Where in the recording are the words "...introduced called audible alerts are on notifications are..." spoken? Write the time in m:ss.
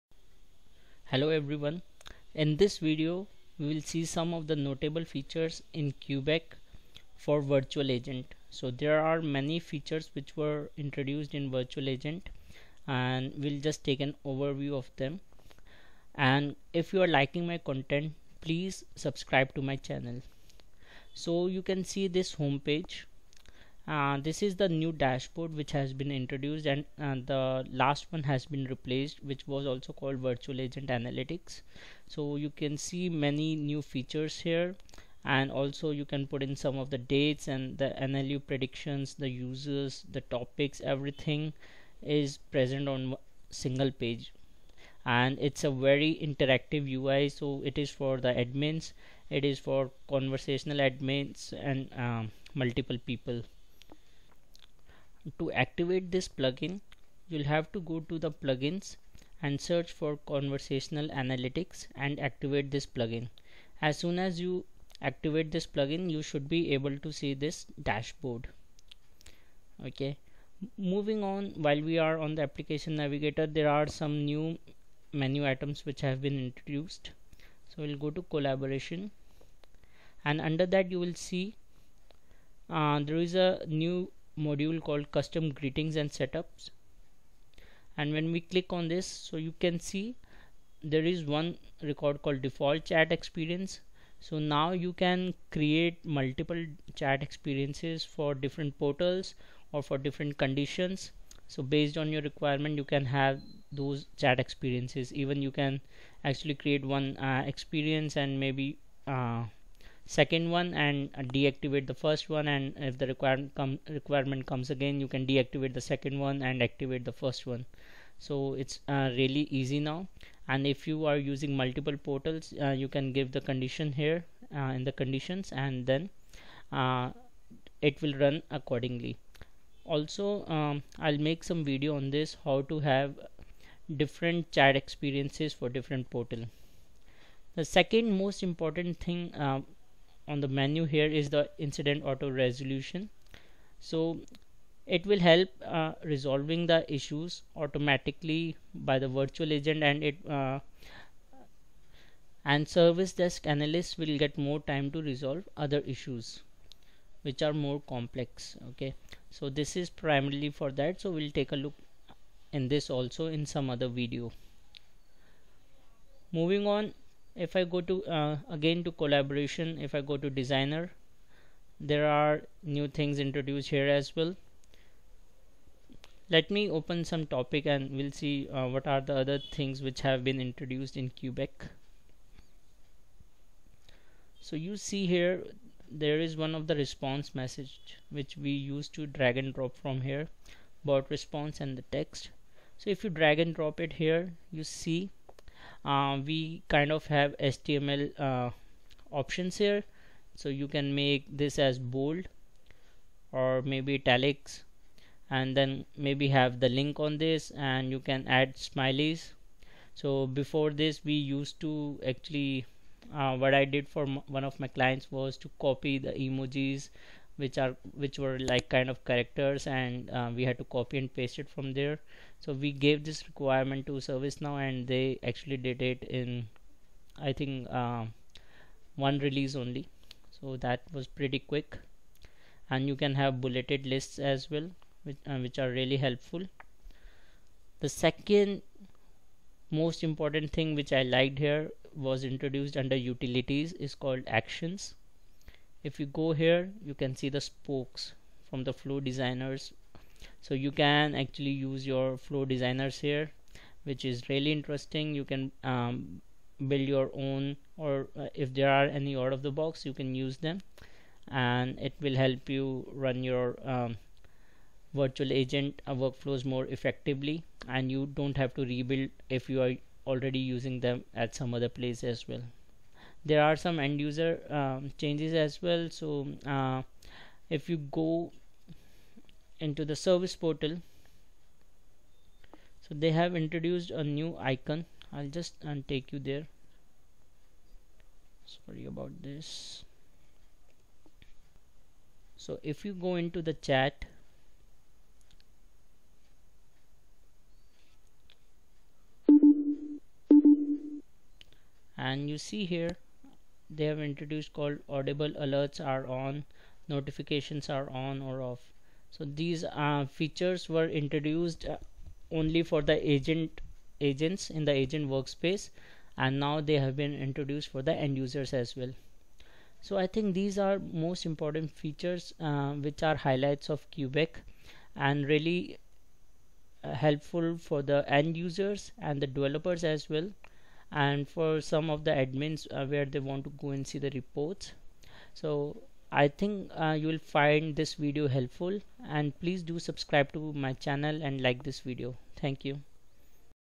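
5:04.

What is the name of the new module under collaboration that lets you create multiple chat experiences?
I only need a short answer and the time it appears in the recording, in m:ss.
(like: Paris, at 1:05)
Custom greetings and setups, at 1:25.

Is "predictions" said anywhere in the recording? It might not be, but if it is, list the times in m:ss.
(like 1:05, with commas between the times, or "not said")
0:38.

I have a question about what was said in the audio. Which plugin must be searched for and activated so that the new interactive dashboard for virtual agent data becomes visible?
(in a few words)
Conversational analytics.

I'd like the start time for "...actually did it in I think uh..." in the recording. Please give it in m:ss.
3:45.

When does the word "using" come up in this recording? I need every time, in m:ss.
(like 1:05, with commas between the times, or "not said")
2:01, 4:30.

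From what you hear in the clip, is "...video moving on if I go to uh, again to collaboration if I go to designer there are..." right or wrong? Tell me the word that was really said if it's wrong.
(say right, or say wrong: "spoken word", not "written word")
right.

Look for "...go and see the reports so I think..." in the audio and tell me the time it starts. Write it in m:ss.
5:33.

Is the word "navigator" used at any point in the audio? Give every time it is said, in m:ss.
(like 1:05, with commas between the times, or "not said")
1:12.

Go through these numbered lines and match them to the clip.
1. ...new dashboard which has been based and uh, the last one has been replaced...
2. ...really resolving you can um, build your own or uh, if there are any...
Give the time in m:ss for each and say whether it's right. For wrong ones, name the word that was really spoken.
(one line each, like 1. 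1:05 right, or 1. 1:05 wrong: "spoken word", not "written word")
1. 0:24 wrong: "introduced", not "based"
2. 4:14 wrong: "interesting", not "resolving".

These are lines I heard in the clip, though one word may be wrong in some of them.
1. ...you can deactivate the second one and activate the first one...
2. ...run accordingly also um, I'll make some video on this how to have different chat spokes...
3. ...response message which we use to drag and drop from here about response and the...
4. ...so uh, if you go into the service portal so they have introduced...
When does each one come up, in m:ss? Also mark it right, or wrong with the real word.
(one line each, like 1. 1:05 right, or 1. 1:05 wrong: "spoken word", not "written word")
1. 1:54 right
2. 2:08 wrong: "experiences", not "spokes"
3. 3:06 right
4. 4:35 right.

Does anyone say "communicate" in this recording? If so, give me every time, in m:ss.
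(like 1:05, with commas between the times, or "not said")
not said.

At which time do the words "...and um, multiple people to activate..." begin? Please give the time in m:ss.
0:51.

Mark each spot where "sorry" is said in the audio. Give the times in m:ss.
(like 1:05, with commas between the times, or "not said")
4:48.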